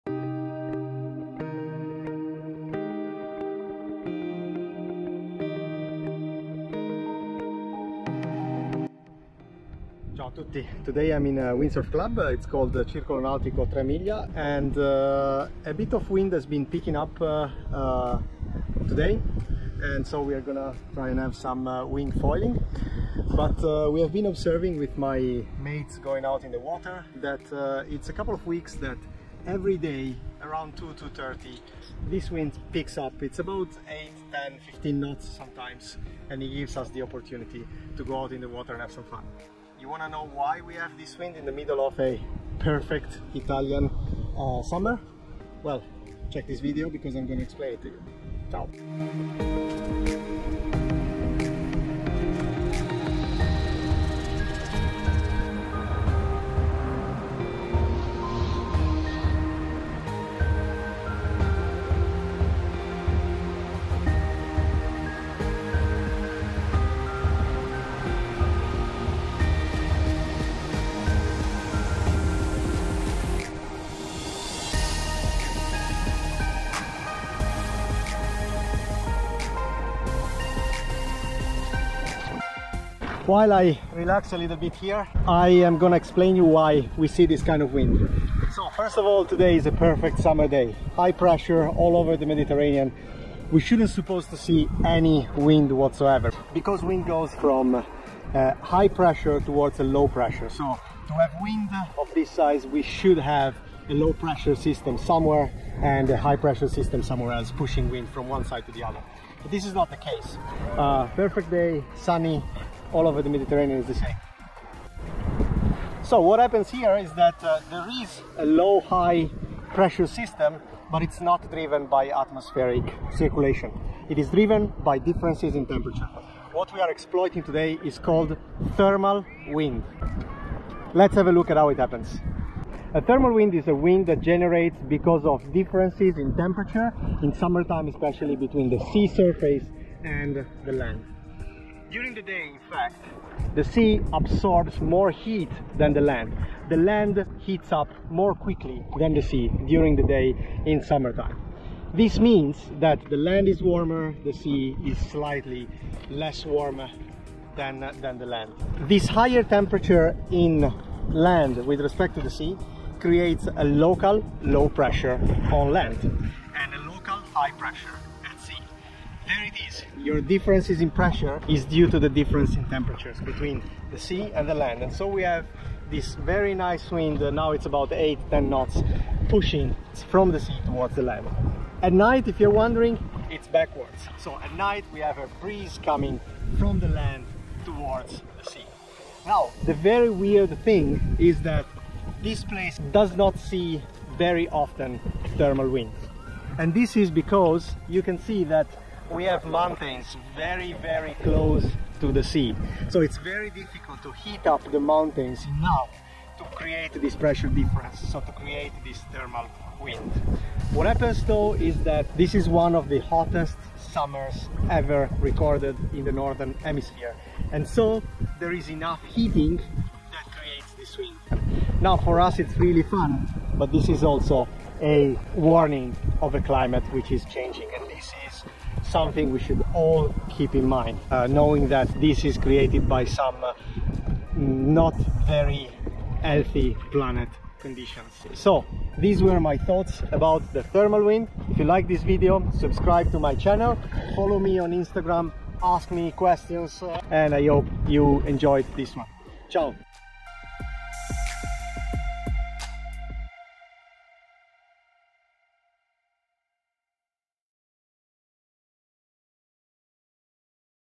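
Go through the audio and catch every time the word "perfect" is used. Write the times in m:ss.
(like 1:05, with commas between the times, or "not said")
0:42, 1:29, 1:51.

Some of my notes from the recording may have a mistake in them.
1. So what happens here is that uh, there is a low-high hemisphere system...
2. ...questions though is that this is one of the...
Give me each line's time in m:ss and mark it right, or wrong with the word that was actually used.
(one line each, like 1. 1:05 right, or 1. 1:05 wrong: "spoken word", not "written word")
1. 1:56 wrong: "pressure", not "hemisphere"
2. 3:30 wrong: "happens", not "questions".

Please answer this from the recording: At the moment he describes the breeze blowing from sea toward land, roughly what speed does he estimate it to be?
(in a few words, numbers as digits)
8-10 knots.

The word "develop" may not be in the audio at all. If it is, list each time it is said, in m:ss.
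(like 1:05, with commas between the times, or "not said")
not said.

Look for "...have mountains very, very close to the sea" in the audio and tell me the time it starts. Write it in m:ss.
3:19.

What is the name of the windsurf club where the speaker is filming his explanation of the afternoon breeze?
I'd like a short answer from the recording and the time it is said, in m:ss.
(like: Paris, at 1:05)
Circolo Nautico Tre Miglia, at 0:12.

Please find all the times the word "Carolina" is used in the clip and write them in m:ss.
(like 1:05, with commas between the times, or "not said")
not said.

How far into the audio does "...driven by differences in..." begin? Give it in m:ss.
2:04.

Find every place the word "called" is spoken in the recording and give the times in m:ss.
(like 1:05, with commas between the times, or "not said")
0:12, 2:07.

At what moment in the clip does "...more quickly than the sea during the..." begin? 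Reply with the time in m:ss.
2:28.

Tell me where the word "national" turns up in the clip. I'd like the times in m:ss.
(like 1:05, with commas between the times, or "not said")
not said.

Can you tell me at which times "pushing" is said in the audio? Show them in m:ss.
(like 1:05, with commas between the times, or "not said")
1:47, 2:59.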